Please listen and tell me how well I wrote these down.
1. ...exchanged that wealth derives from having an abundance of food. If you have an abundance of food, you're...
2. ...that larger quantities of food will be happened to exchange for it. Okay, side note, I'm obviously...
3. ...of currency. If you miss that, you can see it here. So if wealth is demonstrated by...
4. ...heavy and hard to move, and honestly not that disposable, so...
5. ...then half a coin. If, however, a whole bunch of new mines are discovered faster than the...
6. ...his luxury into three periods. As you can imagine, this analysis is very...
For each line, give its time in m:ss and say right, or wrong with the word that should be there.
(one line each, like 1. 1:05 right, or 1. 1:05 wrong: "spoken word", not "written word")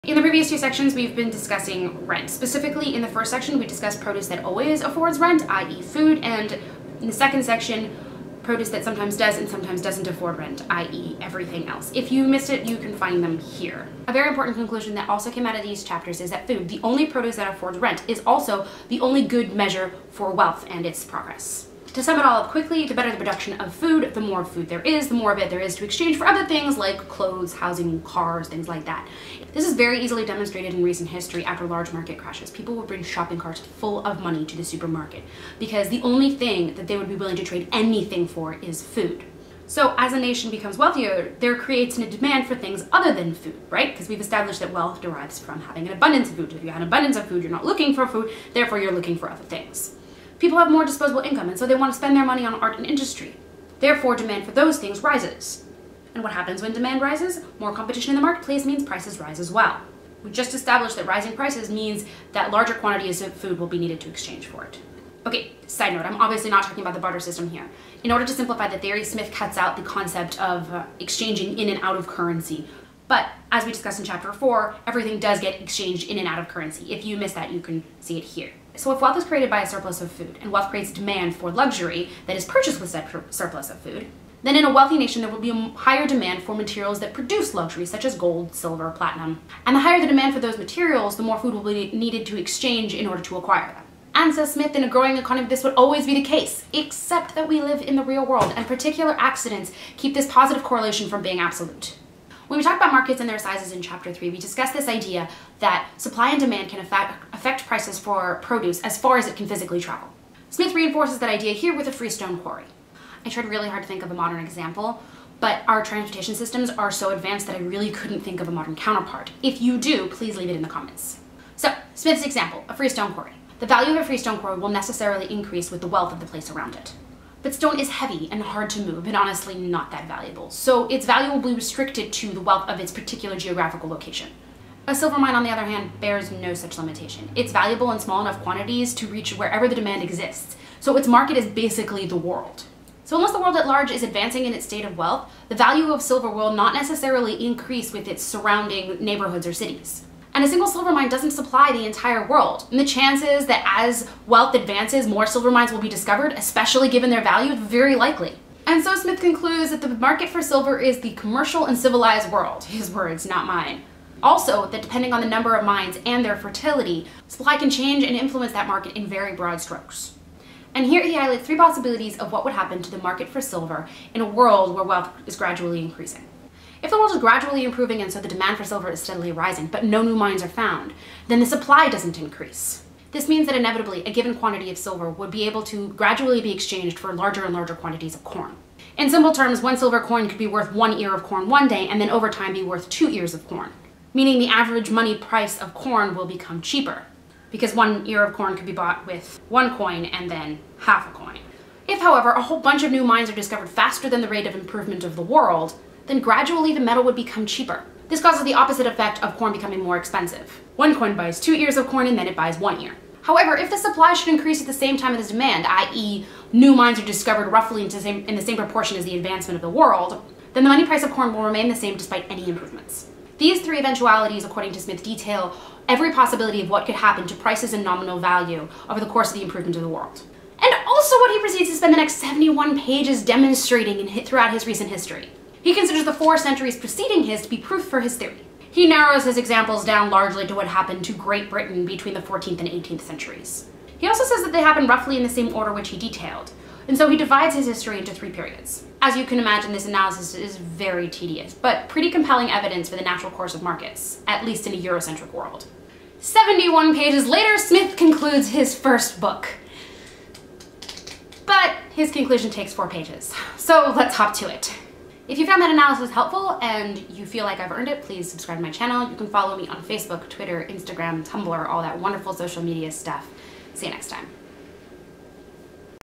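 1. 0:44 wrong: "established", not "exchanged"
2. 1:02 wrong: "needed", not "happened"
3. 1:16 wrong: "created", not "demonstrated"
4. 2:07 wrong: "valuable", not "disposable"
5. 3:20 right
6. 4:07 wrong: "history", not "luxury".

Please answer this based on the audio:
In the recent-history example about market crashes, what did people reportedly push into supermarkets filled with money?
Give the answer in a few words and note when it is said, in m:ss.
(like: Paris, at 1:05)
shopping carts, at 0:33.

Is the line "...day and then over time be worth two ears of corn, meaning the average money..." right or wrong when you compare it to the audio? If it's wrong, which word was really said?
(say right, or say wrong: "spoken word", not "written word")
right.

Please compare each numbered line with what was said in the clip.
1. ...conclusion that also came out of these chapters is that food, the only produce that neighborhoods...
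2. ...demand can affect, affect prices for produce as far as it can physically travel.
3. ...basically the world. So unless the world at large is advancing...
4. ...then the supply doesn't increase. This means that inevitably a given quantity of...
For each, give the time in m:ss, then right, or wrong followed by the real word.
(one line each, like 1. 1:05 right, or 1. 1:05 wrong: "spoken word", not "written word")
1. 0:14 wrong: "affords", not "neighborhoods"
2. 1:46 right
3. 2:21 right
4. 3:01 right.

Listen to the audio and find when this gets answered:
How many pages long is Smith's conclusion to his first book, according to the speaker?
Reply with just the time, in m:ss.
4:22.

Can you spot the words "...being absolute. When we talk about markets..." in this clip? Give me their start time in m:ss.
1:41.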